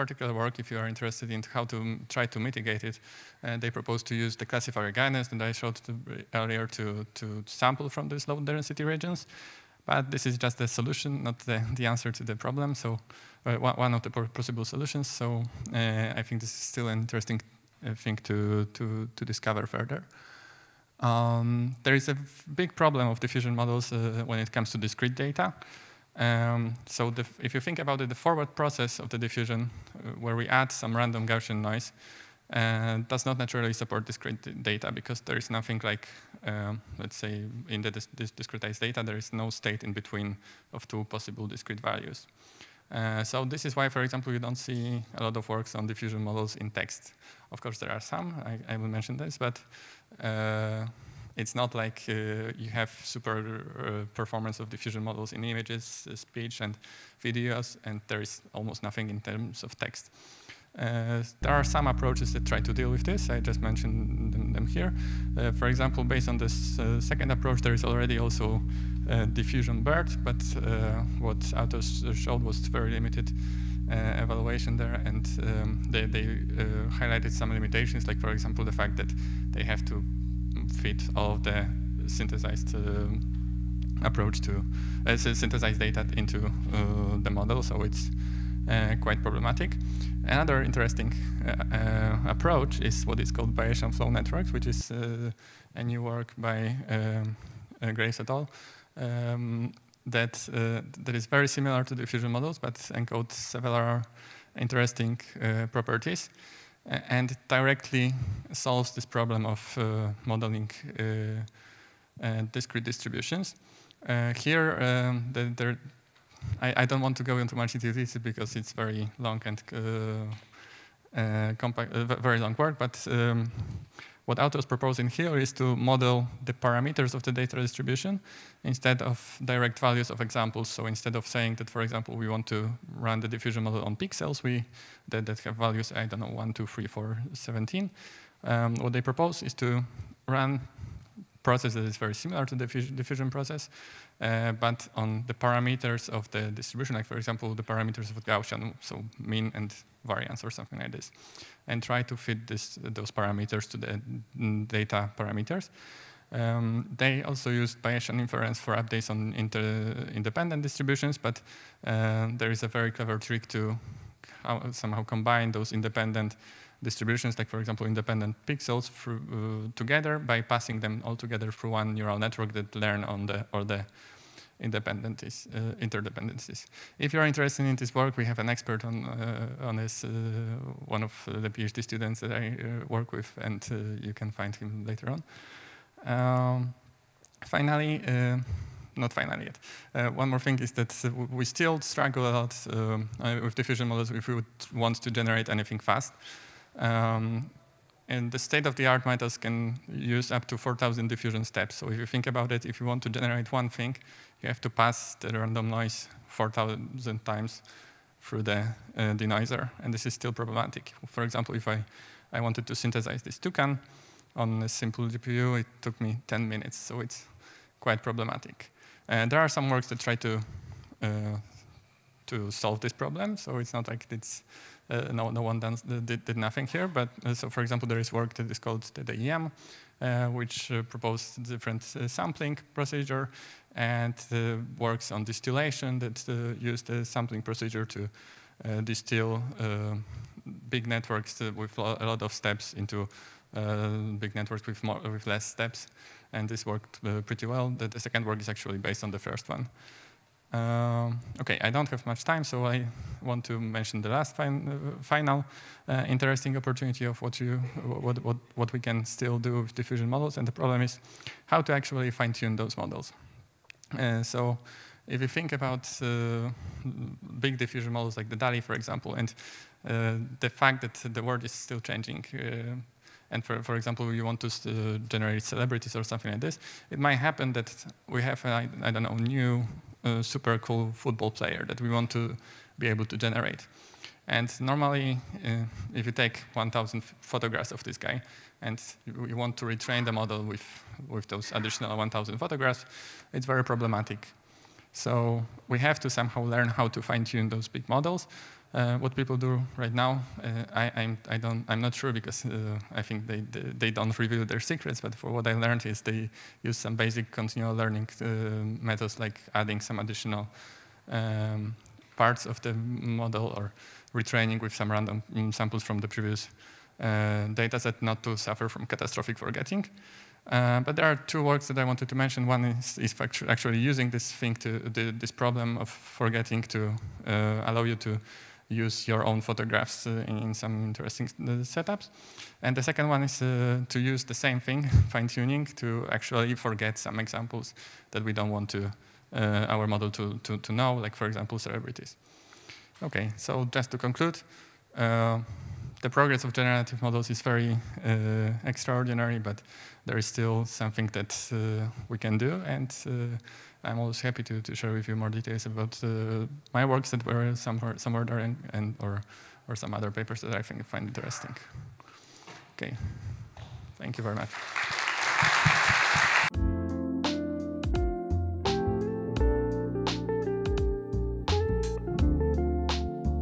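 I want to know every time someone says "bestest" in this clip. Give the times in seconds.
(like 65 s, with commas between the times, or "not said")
not said.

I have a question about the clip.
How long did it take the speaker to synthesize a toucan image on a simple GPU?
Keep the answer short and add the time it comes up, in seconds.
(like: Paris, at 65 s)
10 minutes, at 216 s.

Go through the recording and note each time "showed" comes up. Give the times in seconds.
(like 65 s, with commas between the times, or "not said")
5 s, 72 s.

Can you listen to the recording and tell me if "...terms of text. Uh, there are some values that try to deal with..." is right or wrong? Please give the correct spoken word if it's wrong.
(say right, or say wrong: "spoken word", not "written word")
wrong: "approaches", not "values".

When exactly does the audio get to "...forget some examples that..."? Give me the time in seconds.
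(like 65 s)
336 s.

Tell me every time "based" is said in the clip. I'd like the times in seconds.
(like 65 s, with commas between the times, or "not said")
66 s, 248 s.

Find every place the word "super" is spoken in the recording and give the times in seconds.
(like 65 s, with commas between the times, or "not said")
53 s, 280 s.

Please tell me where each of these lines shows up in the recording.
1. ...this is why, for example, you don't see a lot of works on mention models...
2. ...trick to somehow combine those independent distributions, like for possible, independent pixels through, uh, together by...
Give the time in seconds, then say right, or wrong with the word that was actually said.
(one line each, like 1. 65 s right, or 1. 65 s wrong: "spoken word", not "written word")
1. 43 s wrong: "diffusion", not "mention"
2. 163 s wrong: "example", not "possible".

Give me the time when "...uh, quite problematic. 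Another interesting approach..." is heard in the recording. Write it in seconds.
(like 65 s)
88 s.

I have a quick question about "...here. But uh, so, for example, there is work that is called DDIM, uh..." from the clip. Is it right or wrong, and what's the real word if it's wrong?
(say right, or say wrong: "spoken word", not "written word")
right.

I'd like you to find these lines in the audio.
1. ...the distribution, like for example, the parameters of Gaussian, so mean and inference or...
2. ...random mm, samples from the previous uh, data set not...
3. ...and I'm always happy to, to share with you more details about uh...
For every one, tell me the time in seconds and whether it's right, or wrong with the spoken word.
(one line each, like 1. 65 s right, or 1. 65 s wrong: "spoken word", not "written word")
1. 146 s wrong: "variance", not "inference"
2. 314 s right
3. 352 s right.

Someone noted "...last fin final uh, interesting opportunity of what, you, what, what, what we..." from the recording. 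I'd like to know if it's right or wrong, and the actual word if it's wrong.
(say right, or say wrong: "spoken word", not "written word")
right.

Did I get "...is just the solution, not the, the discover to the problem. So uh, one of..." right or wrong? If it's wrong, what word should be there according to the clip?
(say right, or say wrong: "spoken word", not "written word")
wrong: "answer", not "discover".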